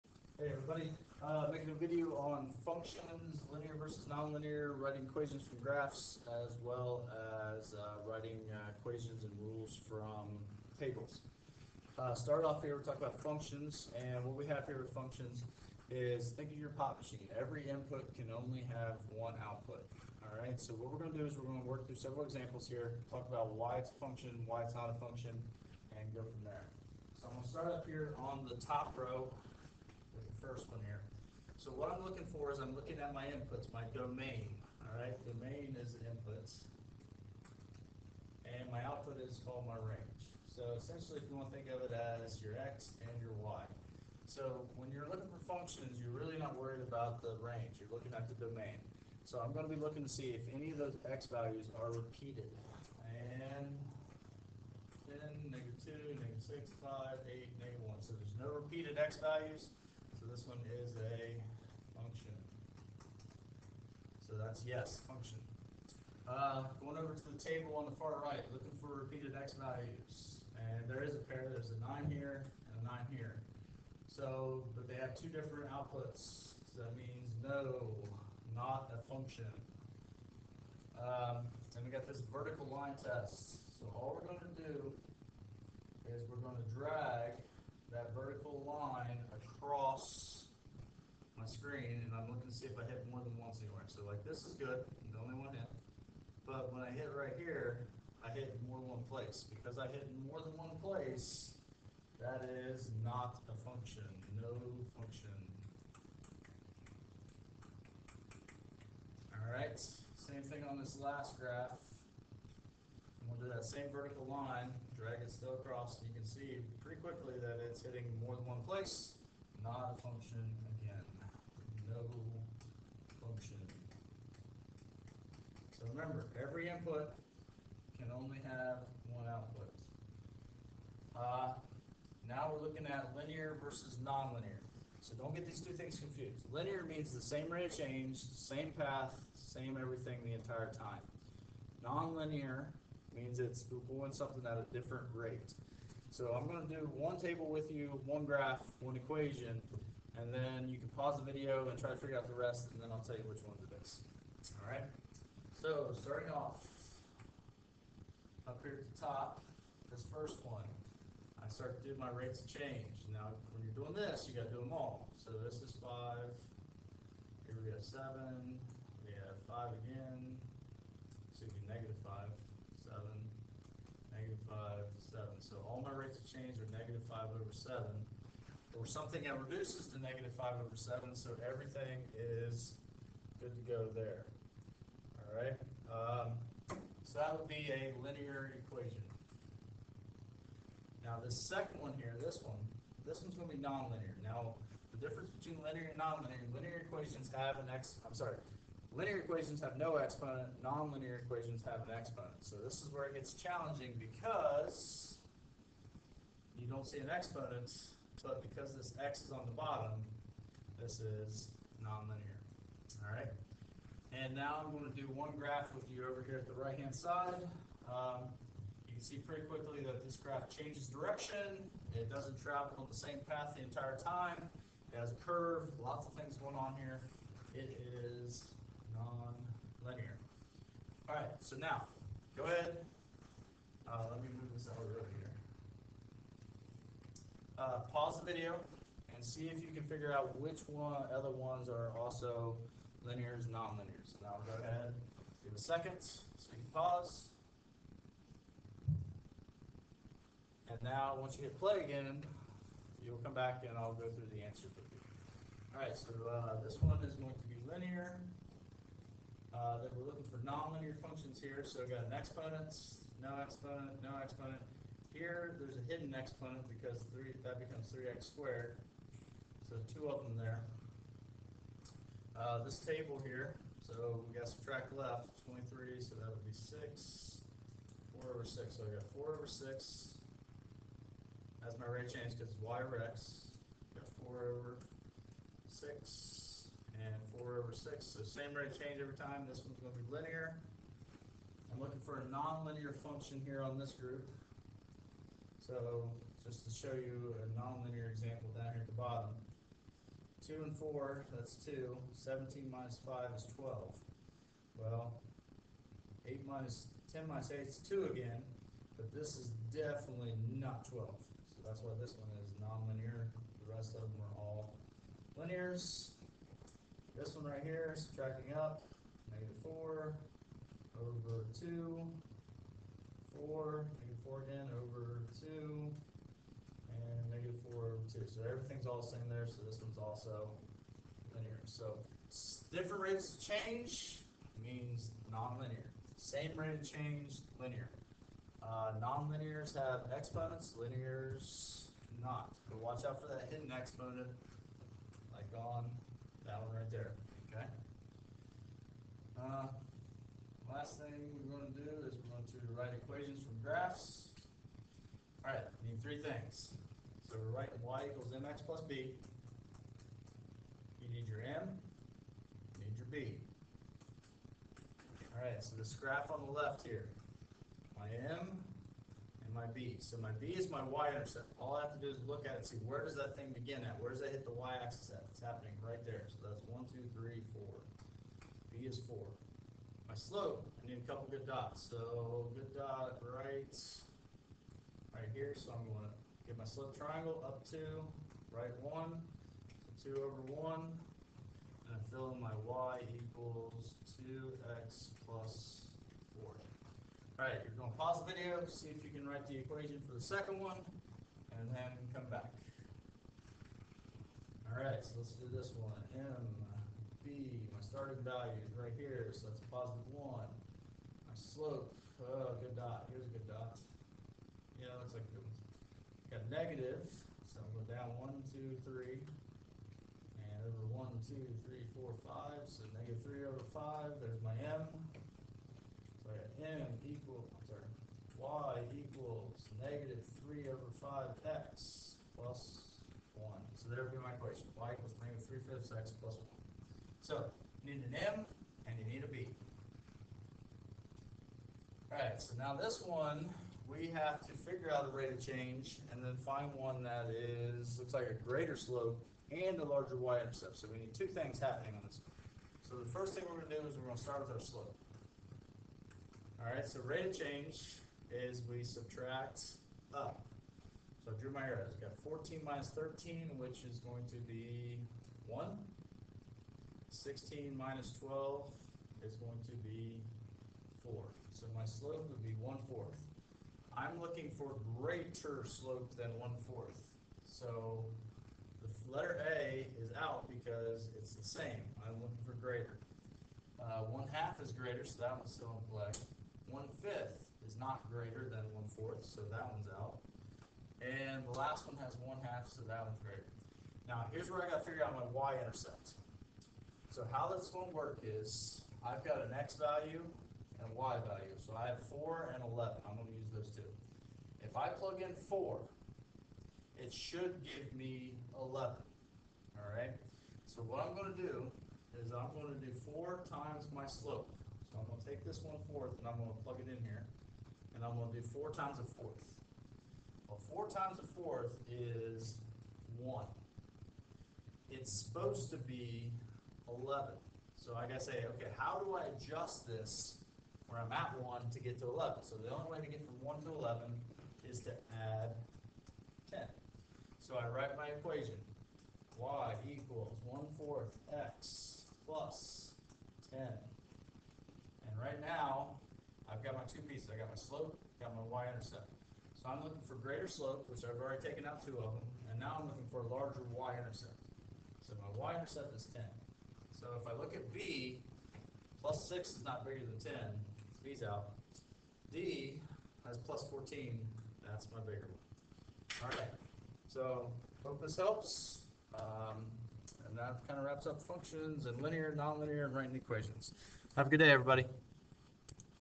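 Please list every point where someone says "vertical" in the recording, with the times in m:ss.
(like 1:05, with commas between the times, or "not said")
1:22, 1:28, 1:53.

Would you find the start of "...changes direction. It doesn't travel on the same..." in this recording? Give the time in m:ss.
3:40.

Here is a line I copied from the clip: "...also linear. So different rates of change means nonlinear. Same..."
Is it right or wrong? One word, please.
right.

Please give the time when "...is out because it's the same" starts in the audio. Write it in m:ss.
8:00.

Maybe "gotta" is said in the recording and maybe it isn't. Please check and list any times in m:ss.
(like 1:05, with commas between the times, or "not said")
8:14.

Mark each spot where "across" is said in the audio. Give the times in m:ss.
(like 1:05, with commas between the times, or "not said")
1:29, 1:55.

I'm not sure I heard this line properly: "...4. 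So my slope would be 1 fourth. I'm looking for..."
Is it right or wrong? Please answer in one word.
right.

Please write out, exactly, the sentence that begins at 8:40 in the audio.
Well, four times a fourth is one.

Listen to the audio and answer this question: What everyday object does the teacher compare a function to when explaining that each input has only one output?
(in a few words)
pop machine.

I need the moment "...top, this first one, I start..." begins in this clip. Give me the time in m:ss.
2:38.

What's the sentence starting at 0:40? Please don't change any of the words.
So essentially, if you want to think of it as your X and your Y.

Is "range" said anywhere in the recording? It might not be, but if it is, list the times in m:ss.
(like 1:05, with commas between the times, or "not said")
0:39, 0:47.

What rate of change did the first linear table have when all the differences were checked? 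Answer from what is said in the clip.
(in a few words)
negative 5 over 7.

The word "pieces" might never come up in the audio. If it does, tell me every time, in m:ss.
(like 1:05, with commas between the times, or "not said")
9:07.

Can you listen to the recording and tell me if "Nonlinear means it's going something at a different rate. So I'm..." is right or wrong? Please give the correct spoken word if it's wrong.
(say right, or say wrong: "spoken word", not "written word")
right.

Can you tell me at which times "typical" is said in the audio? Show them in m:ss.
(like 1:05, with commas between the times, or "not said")
not said.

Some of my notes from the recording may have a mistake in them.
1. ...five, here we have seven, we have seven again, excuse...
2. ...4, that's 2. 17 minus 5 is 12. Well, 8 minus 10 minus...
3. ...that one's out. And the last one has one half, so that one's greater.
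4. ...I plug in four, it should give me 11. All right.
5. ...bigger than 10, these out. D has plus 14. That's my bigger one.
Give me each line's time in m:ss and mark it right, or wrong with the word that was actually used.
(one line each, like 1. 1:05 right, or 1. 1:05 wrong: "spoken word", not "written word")
1. 2:45 wrong: "five", not "seven"
2. 5:00 right
3. 8:09 right
4. 8:24 right
5. 9:19 right.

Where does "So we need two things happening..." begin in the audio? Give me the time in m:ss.
7:30.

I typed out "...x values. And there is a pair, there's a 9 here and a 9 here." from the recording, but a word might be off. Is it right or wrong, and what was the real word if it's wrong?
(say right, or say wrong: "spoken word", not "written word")
right.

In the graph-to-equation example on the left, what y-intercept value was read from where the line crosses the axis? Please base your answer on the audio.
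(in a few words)
4.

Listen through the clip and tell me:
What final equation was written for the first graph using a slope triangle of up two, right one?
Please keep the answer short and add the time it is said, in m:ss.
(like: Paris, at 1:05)
y = 2x + 4, at 6:32.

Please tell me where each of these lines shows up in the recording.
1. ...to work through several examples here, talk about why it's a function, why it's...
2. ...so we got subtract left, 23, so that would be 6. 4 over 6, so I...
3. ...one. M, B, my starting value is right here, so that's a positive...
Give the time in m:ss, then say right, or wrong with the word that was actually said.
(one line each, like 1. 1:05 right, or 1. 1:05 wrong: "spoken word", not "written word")
1. 0:21 right
2. 4:33 right
3. 6:45 right.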